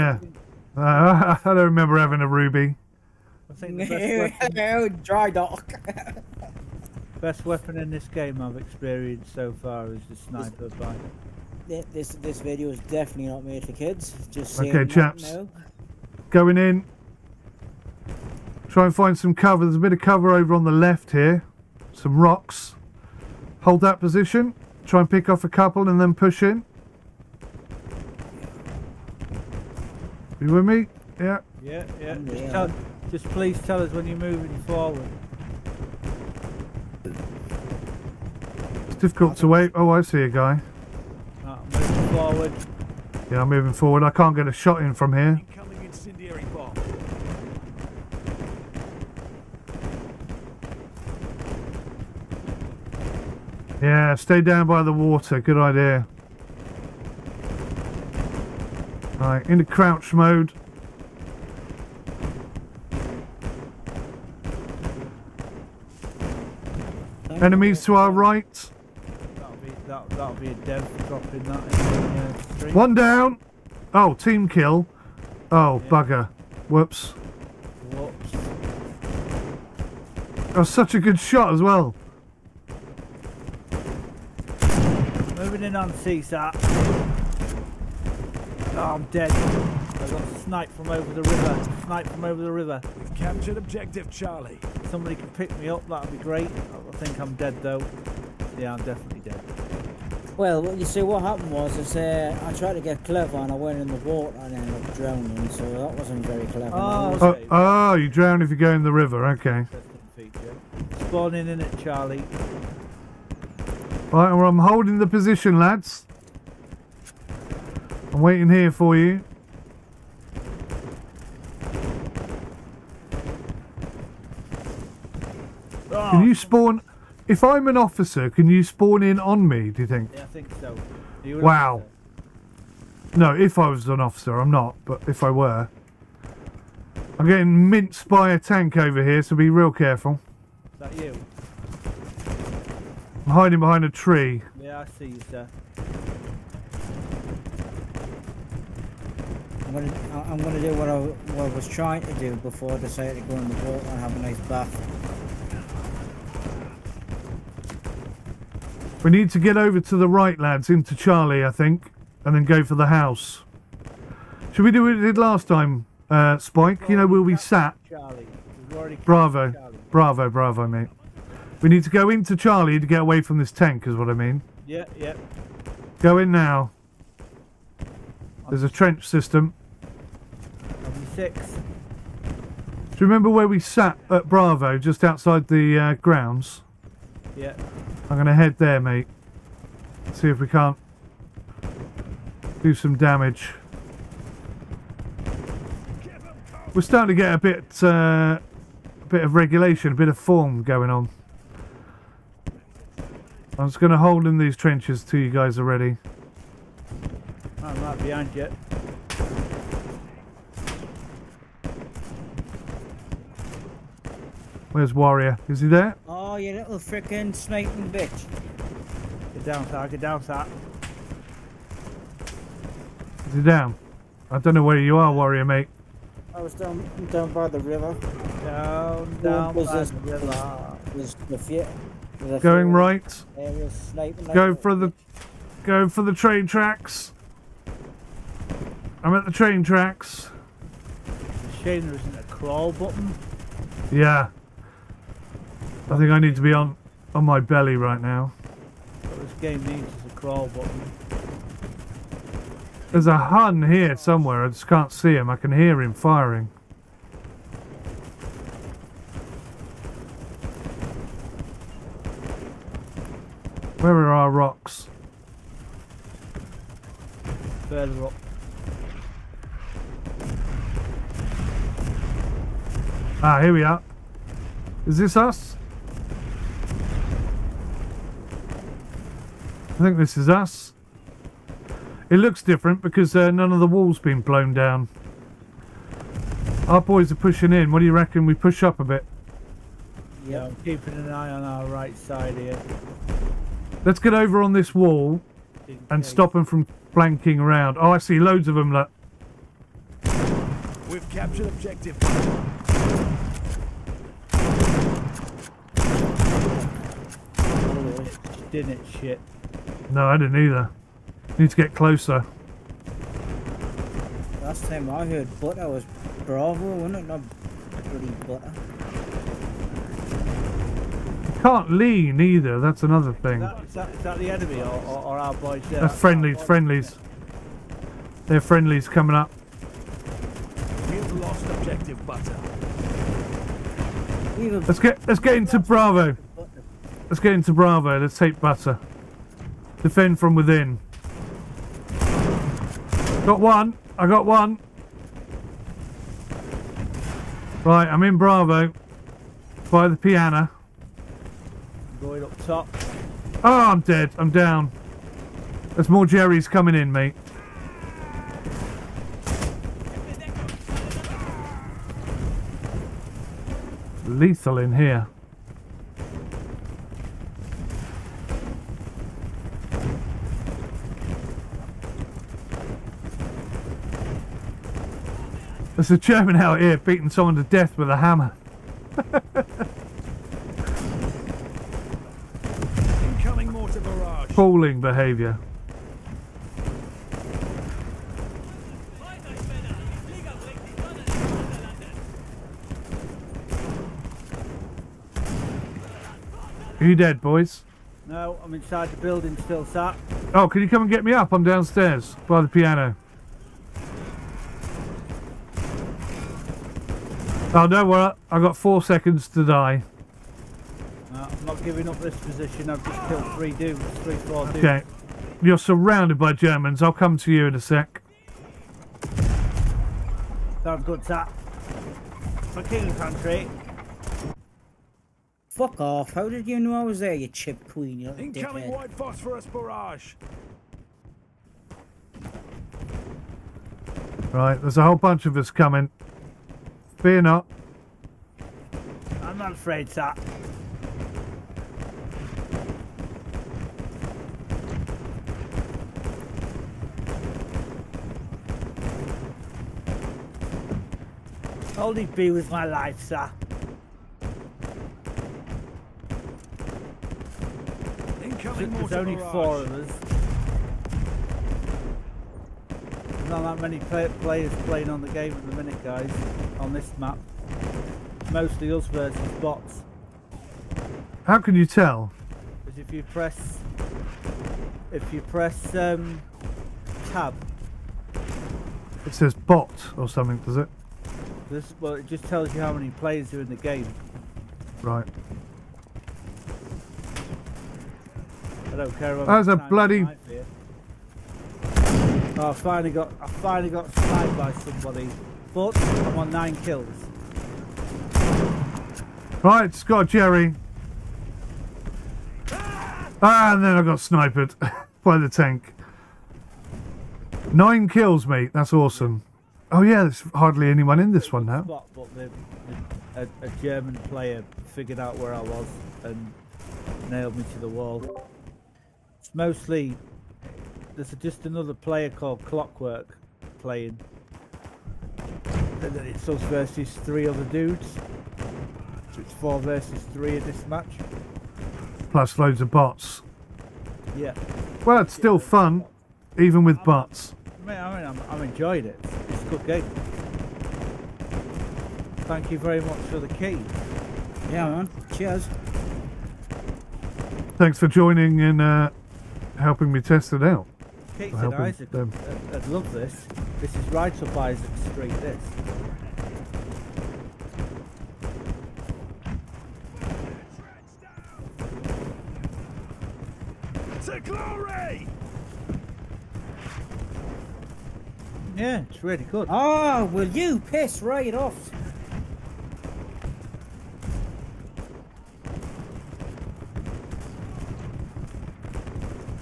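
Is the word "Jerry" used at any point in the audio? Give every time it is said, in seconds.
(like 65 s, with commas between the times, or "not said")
356 s, 500 s.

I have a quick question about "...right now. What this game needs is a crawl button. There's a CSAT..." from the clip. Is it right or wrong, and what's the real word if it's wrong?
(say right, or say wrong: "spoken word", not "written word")
wrong: "Hun", not "CSAT".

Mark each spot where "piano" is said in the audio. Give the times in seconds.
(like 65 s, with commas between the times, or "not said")
349 s, 402 s.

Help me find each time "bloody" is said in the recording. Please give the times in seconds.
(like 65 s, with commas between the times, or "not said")
317 s, 489 s.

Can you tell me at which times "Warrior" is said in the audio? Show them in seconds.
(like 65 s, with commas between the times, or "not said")
214 s, 225 s.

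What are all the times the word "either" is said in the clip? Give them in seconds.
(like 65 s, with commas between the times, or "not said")
310 s, 322 s.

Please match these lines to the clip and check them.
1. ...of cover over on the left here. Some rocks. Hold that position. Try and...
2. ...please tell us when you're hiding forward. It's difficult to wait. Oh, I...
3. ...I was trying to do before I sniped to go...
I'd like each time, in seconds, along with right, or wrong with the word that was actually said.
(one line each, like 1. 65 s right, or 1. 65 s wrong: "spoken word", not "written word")
1. 19 s right
2. 33 s wrong: "moving", not "hiding"
3. 151 s wrong: "decided", not "sniped".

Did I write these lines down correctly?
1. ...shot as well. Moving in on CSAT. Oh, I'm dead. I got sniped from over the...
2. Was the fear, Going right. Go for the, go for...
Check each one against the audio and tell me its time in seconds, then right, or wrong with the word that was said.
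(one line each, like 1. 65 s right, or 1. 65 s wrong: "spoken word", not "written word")
1. 81 s right
2. 230 s right.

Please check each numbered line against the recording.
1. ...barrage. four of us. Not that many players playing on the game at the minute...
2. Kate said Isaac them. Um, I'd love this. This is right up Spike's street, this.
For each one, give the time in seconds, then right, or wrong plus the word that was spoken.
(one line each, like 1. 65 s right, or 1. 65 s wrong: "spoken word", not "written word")
1. 459 s right
2. 551 s wrong: "Isaac", not "Spike".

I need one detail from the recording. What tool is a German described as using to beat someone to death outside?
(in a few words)
A hammer.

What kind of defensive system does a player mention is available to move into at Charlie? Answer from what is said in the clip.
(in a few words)
A trench system.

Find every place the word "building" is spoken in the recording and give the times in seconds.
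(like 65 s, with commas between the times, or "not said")
398 s.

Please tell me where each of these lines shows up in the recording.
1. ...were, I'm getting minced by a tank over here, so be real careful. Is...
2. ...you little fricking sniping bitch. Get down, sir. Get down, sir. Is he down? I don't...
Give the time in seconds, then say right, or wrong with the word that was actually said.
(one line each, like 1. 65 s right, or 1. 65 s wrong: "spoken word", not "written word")
1. 135 s right
2. 216 s right.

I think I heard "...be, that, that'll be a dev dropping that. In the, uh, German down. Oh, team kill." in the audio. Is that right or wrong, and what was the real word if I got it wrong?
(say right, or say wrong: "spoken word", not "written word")
wrong: "One", not "German".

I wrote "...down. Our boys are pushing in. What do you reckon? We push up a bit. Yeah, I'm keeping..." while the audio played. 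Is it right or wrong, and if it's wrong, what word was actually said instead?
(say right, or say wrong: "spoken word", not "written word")
right.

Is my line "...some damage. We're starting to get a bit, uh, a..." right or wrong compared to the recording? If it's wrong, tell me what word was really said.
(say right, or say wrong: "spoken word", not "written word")
right.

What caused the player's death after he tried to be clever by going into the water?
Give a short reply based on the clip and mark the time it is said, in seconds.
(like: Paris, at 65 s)
Drowning, at 104 s.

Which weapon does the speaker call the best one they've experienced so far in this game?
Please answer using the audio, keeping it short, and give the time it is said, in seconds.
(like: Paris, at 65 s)
The sniper, at 10 s.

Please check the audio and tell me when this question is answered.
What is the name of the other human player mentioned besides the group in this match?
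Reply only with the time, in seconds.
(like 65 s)
522 s.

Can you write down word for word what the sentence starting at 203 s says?
I'm just going to hold in these trenches till you guys are ready.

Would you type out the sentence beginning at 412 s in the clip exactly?
I've just killed three dudes, three, four dudes.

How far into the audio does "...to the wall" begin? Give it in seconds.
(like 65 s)
517 s.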